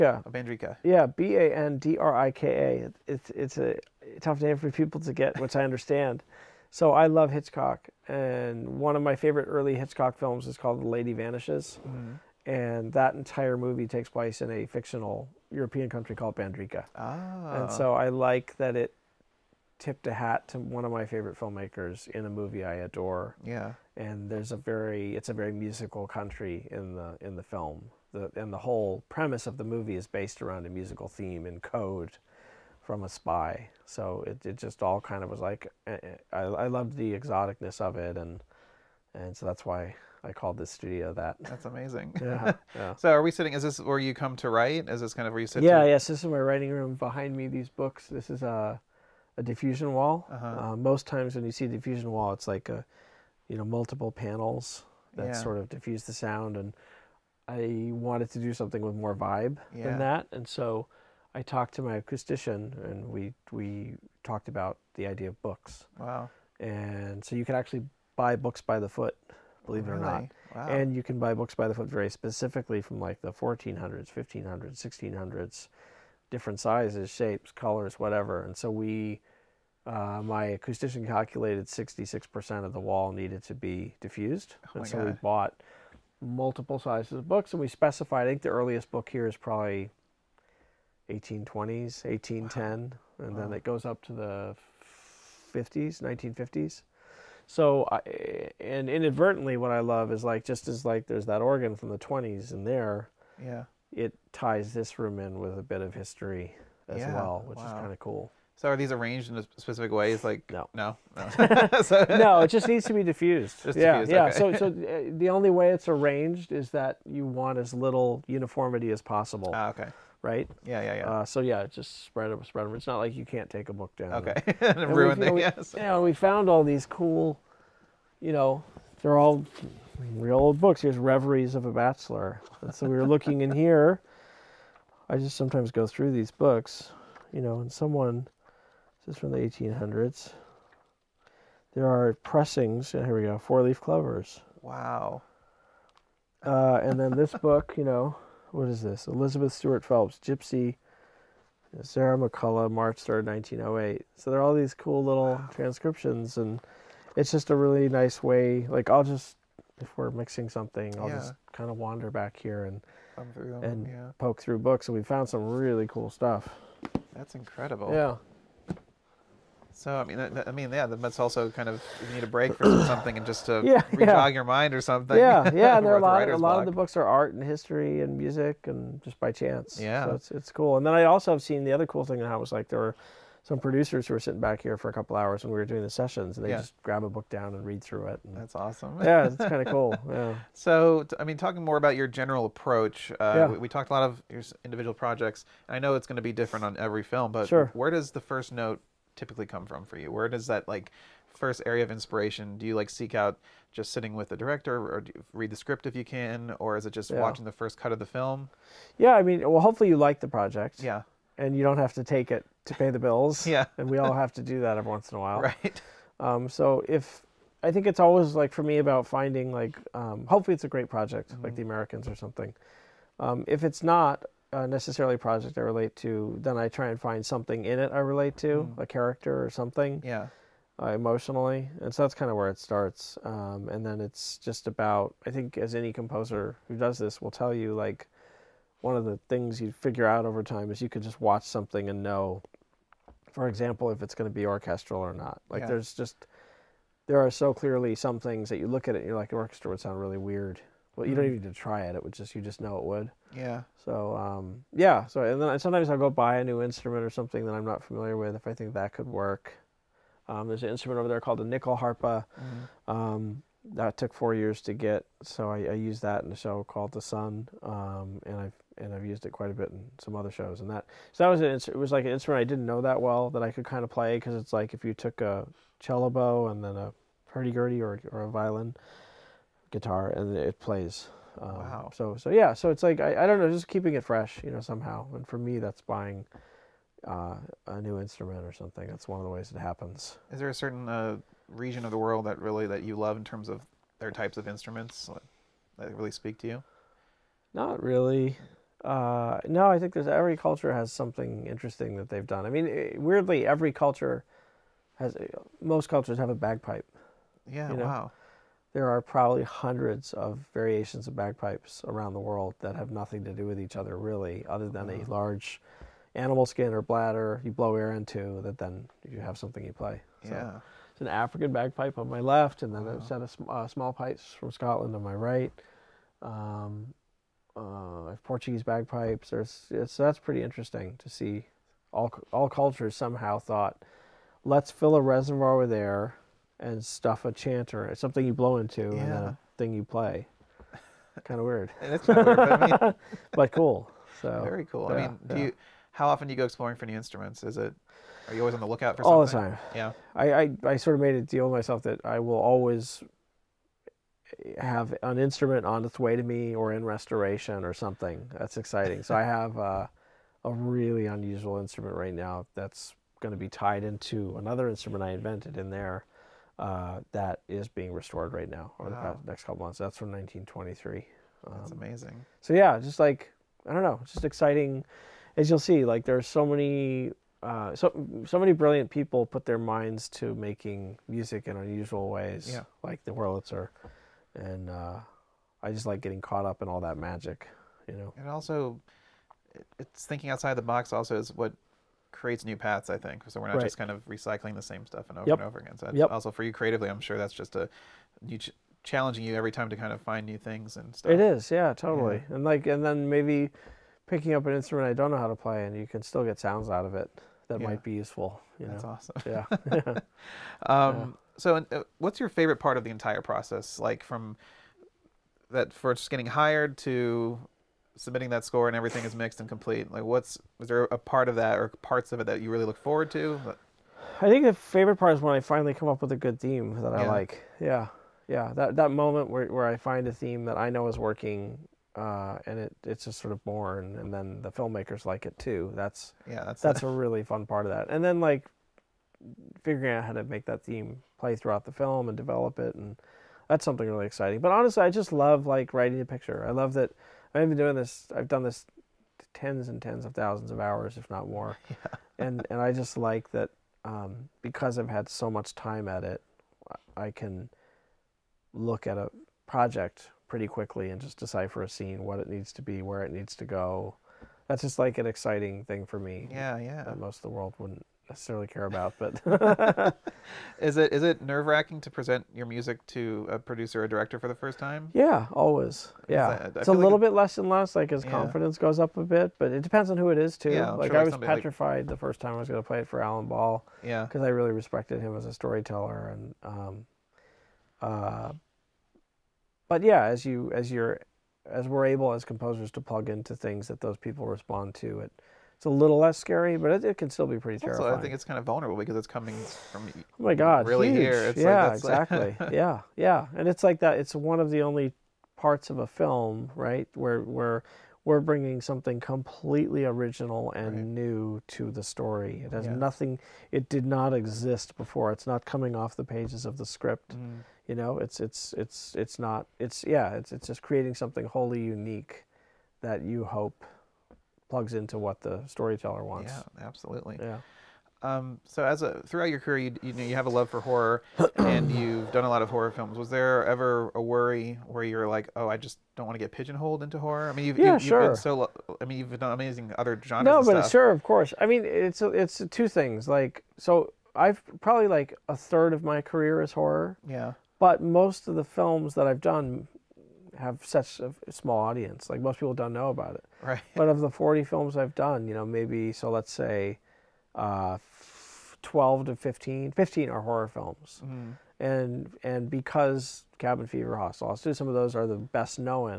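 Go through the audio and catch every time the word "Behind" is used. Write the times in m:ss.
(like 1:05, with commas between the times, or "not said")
0:46.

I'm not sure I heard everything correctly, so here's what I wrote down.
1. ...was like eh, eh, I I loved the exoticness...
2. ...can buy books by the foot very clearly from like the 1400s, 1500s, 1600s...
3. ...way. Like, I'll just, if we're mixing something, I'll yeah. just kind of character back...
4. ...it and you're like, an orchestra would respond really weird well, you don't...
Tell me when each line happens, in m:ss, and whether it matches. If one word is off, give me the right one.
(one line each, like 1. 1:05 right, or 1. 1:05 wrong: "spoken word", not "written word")
1. 0:35 right
2. 1:11 wrong: "specifically", not "clearly"
3. 2:38 wrong: "wander", not "character"
4. 4:08 wrong: "sound", not "respond".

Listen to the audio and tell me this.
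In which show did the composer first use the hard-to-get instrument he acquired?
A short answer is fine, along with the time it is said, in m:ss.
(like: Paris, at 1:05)
The Son, at 4:26.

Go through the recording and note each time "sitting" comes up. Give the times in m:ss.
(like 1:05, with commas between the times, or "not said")
0:43, 3:04, 3:23.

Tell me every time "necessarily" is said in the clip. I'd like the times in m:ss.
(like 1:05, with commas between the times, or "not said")
3:44, 7:48.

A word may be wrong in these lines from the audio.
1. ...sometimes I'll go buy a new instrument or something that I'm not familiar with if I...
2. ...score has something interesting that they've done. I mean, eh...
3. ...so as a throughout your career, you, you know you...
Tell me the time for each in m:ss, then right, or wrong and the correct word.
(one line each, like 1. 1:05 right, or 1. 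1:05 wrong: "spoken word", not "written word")
1. 4:15 right
2. 5:00 wrong: "culture", not "score"
3. 8:48 right.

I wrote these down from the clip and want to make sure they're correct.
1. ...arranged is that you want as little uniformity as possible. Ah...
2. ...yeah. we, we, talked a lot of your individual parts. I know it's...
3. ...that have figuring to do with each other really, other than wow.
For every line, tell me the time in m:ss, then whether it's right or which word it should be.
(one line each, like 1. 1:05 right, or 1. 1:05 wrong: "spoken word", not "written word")
1. 1:55 right
2. 3:13 wrong: "projects", not "parts"
3. 5:12 wrong: "nothing", not "figuring".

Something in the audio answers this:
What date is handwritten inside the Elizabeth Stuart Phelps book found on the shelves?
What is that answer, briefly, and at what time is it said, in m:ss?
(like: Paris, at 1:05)
March 3rd, 1908, at 2:32.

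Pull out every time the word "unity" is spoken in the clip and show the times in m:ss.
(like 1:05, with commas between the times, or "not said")
not said.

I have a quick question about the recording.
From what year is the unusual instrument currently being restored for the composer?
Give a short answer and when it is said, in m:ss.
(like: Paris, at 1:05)
1923, at 6:10.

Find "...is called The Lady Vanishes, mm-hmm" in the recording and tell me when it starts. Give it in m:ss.
0:10.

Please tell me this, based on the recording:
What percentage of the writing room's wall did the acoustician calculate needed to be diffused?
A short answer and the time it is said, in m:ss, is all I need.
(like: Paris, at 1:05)
66%, at 1:21.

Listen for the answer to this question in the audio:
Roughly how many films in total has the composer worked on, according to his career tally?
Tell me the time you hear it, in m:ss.
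9:14.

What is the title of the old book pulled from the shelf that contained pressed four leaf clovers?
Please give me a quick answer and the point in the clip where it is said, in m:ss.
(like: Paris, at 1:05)
Reveries of a Bachelor, at 2:10.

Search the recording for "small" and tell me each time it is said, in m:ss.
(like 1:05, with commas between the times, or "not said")
5:23, 9:11.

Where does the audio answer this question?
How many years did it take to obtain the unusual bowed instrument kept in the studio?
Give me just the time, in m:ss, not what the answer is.
4:24.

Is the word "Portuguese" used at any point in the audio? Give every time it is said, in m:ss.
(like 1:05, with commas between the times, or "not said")
5:28.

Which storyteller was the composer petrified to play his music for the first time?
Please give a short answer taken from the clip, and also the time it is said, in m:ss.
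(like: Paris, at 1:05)
Alan Ball, at 8:03.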